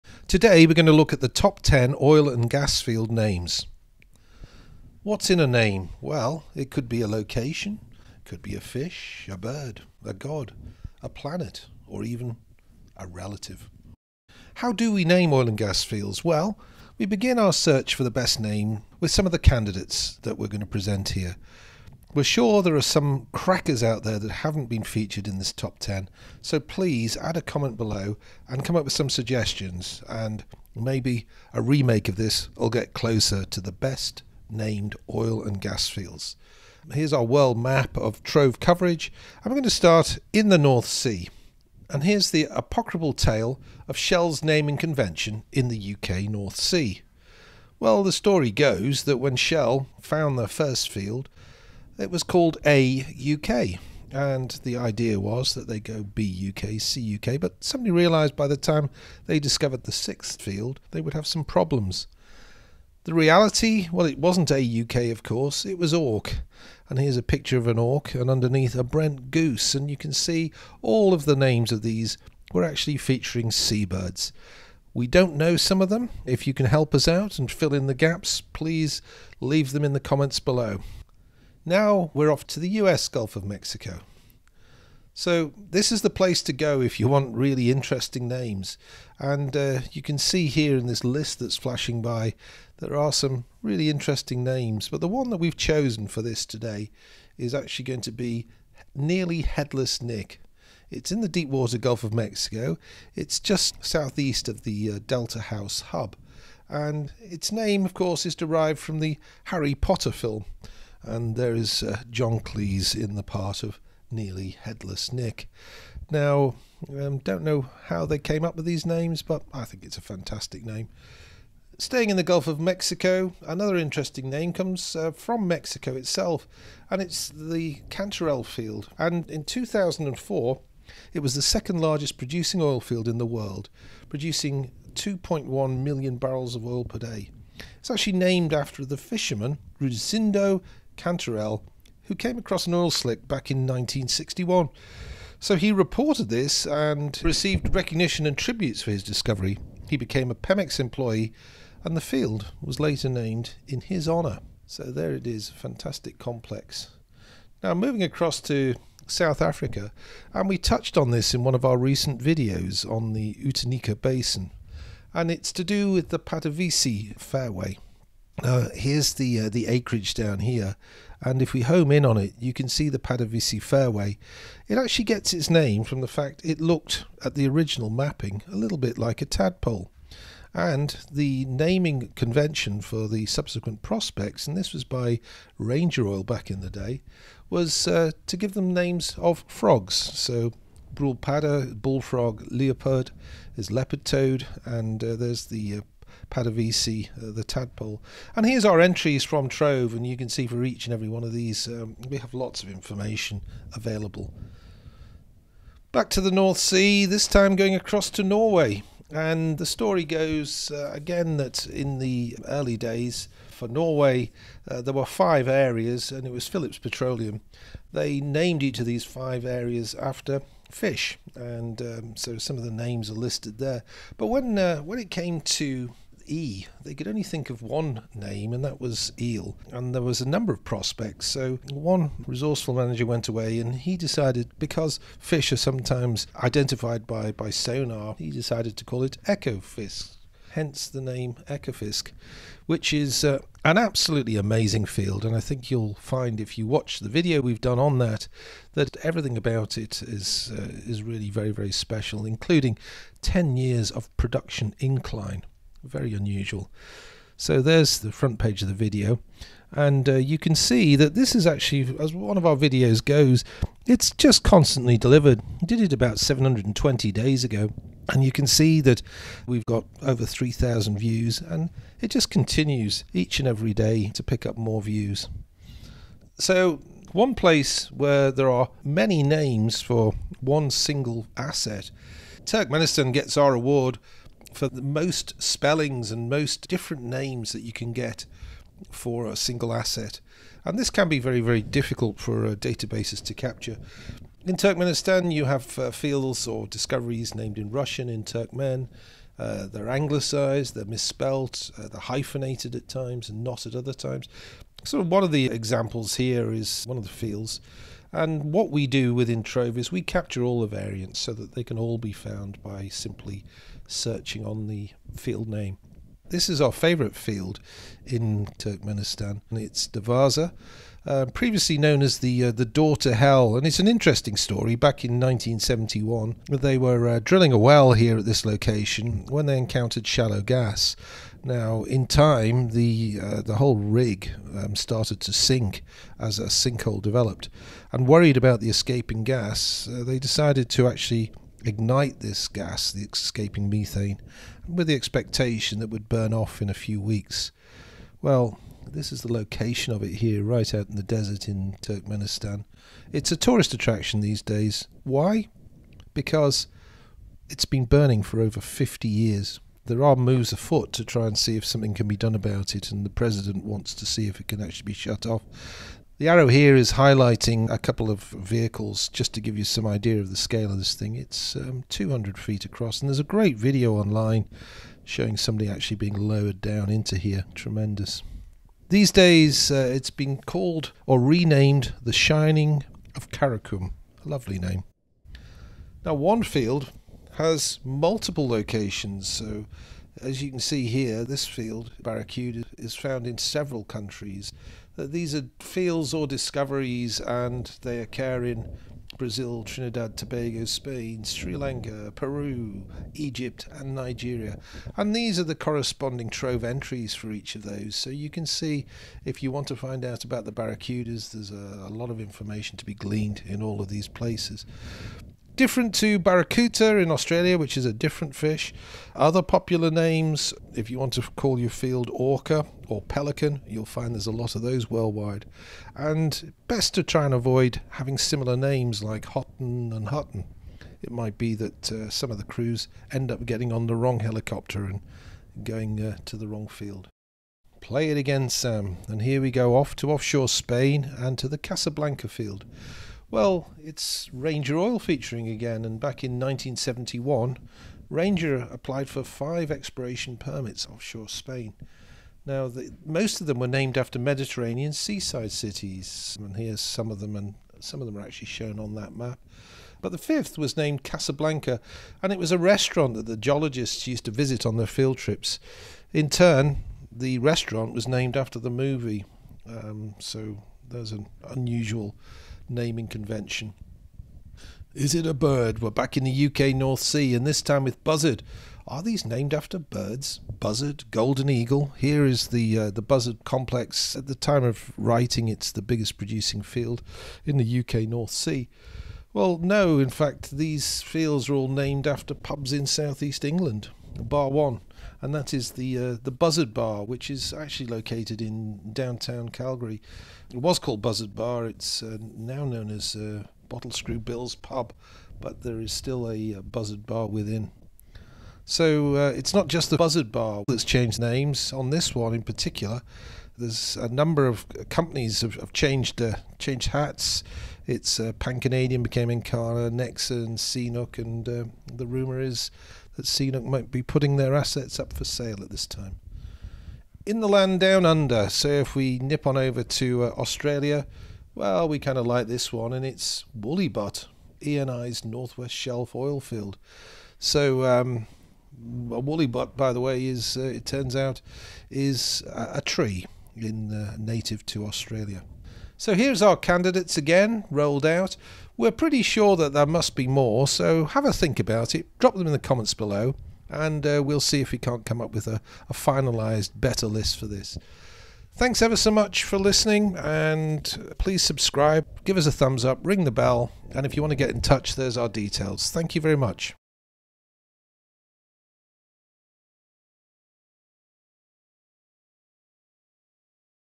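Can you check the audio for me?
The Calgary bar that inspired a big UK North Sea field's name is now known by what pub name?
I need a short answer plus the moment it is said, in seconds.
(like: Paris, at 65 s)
Bottle Screw Bill's Pub, at 503 s.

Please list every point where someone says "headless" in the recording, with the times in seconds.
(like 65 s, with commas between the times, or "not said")
99 s, 114 s.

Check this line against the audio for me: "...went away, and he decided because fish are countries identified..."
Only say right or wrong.
wrong.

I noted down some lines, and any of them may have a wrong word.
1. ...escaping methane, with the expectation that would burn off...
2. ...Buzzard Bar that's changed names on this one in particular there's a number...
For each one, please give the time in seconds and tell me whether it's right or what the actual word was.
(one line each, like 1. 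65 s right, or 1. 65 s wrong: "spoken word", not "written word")
1. 343 s right
2. 509 s right.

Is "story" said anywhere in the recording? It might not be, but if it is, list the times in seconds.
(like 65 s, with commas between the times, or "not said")
48 s, 209 s, 324 s.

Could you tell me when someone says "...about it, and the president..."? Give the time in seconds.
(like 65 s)
362 s.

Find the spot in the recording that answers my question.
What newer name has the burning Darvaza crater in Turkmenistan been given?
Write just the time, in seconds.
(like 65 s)
382 s.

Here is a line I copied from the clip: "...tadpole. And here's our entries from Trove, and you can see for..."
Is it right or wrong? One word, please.
right.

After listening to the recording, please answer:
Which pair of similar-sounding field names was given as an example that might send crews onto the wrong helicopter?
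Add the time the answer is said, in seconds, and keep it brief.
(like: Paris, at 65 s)
Hotton and Hutton, at 429 s.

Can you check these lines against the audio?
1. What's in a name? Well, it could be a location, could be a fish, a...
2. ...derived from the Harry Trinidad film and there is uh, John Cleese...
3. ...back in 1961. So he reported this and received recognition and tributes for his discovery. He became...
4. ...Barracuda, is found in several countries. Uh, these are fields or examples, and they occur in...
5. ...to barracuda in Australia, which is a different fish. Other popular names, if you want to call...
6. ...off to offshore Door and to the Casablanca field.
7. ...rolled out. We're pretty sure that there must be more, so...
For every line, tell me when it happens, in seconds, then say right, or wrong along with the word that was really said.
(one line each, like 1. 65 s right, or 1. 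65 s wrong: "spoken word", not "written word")
1. 5 s right
2. 108 s wrong: "Potter", not "Trinidad"
3. 143 s right
4. 392 s wrong: "discoveries", not "examples"
5. 415 s right
6. 439 s wrong: "Spain", not "Door"
7. 547 s right.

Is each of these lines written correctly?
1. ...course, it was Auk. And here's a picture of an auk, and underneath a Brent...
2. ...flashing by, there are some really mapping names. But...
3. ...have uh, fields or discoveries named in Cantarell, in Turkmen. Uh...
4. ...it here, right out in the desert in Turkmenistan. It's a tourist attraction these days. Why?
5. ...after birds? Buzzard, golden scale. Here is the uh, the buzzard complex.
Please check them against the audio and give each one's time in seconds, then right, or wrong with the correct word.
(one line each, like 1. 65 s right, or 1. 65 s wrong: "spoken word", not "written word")
1. 65 s right
2. 91 s wrong: "interesting", not "mapping"
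3. 295 s wrong: "Russian", not "Cantarell"
4. 350 s right
5. 479 s wrong: "eagle", not "scale".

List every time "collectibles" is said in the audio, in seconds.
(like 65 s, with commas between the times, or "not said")
not said.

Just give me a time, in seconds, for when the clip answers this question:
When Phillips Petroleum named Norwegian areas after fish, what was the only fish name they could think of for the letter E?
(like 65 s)
229 s.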